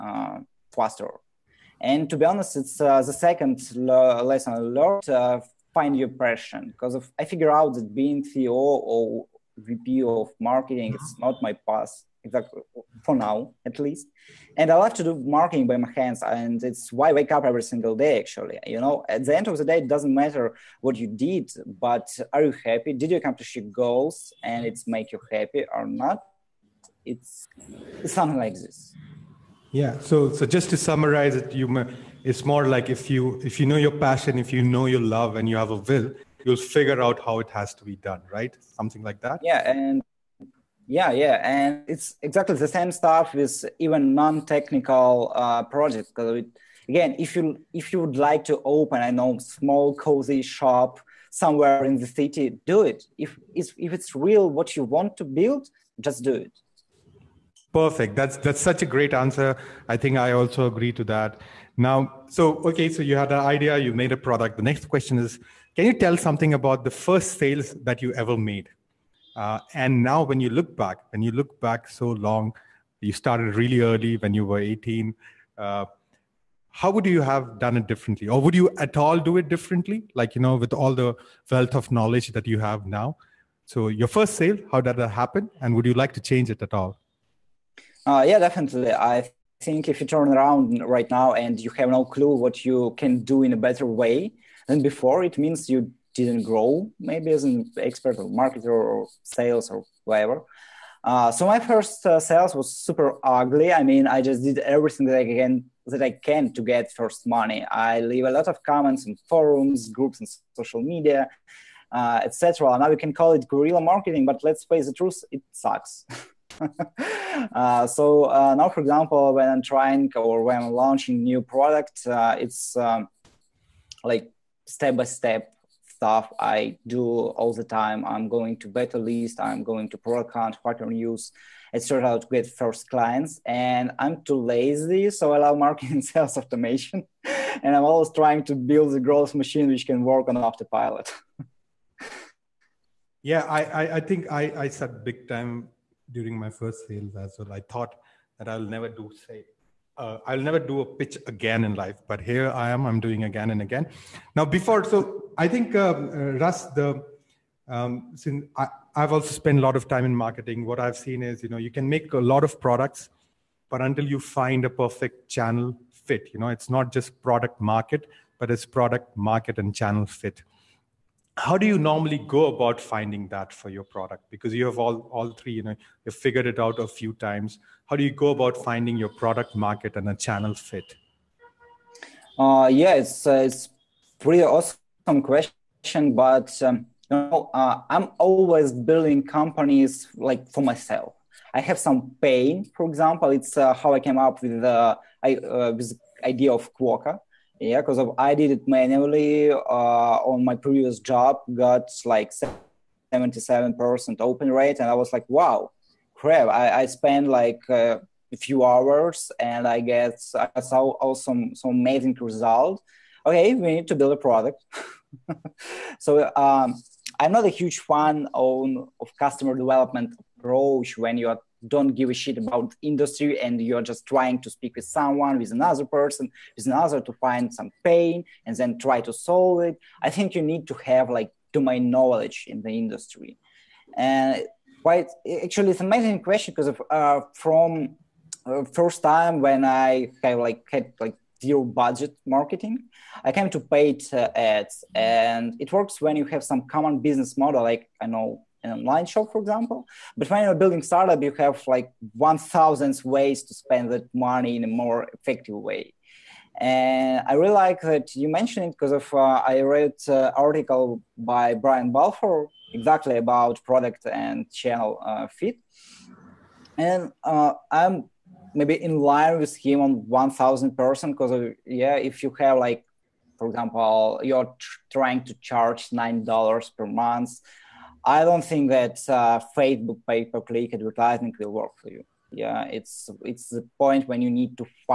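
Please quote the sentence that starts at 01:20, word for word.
Like, you know, with all the wealth of knowledge that you have now.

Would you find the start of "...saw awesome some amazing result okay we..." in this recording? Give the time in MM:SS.
03:30.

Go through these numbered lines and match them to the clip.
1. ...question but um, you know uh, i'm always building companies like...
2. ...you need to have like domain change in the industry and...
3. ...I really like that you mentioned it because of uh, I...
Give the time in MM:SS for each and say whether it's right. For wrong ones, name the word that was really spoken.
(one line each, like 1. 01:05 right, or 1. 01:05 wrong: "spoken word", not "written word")
1. 03:05 right
2. 03:50 wrong: "knowledge", not "change"
3. 04:17 right.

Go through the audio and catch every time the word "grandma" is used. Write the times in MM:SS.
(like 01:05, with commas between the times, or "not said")
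not said.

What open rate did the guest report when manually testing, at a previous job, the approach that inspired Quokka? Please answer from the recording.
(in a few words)
77%.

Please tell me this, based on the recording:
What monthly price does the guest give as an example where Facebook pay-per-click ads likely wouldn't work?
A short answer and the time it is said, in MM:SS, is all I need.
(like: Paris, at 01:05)
$9, at 04:35.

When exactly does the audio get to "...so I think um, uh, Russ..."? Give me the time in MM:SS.
02:34.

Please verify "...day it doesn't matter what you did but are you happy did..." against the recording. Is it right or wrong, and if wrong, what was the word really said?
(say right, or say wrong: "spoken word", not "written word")
right.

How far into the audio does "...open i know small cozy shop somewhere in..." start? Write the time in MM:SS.
00:48.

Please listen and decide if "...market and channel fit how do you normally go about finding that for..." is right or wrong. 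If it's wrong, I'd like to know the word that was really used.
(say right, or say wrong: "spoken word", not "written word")
right.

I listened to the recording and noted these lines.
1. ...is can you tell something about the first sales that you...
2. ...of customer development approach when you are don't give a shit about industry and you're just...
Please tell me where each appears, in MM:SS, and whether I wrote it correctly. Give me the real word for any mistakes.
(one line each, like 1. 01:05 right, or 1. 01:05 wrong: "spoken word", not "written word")
1. 01:05 right
2. 03:39 right.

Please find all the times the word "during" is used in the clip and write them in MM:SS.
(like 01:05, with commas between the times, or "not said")
02:26.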